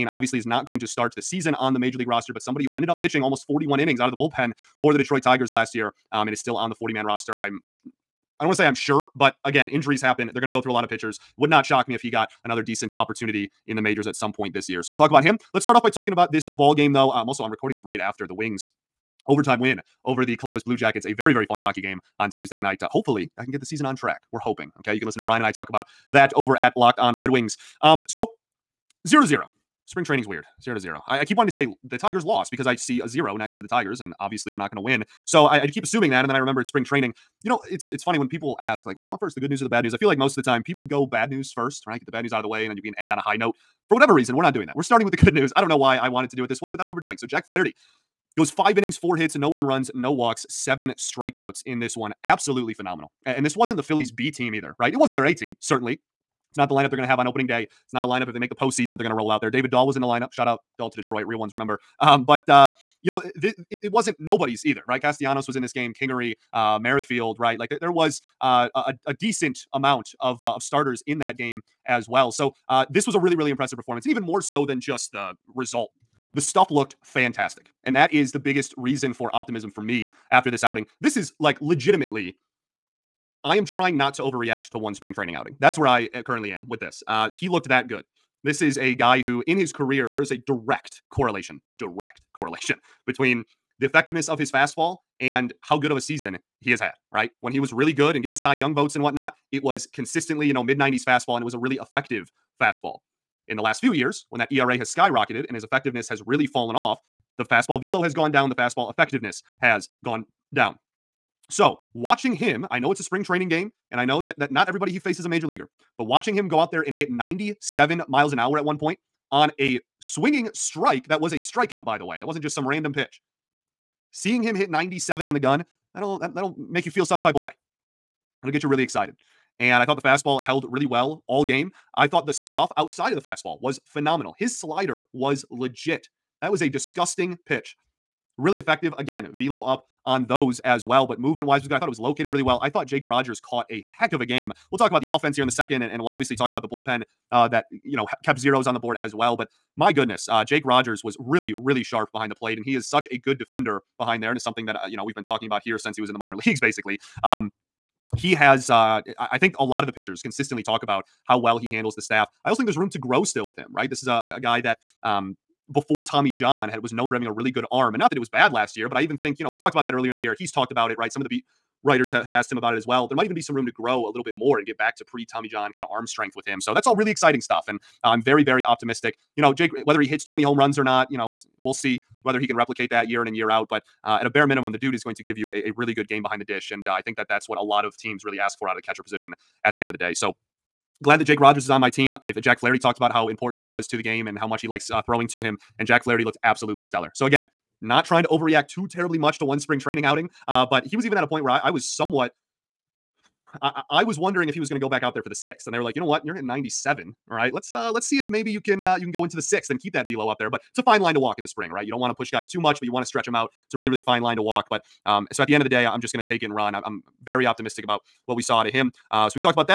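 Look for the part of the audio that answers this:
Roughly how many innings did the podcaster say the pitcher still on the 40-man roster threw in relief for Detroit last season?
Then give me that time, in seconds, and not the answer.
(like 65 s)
3 s.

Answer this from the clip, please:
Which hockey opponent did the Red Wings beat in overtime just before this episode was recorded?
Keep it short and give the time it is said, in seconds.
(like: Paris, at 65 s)
Columbus Blue Jackets, at 20 s.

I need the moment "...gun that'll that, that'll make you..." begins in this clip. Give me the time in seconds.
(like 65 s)
125 s.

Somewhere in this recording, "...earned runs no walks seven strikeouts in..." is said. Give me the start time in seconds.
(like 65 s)
49 s.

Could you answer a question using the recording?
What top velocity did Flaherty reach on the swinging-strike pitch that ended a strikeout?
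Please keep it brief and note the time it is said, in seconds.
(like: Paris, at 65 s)
97 mph, at 117 s.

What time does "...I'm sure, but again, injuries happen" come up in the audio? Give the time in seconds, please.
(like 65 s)
8 s.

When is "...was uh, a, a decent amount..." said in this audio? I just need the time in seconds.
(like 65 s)
67 s.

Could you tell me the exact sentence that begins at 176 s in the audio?
So that's all really exciting stuff, and uh, I'm very very optimistic.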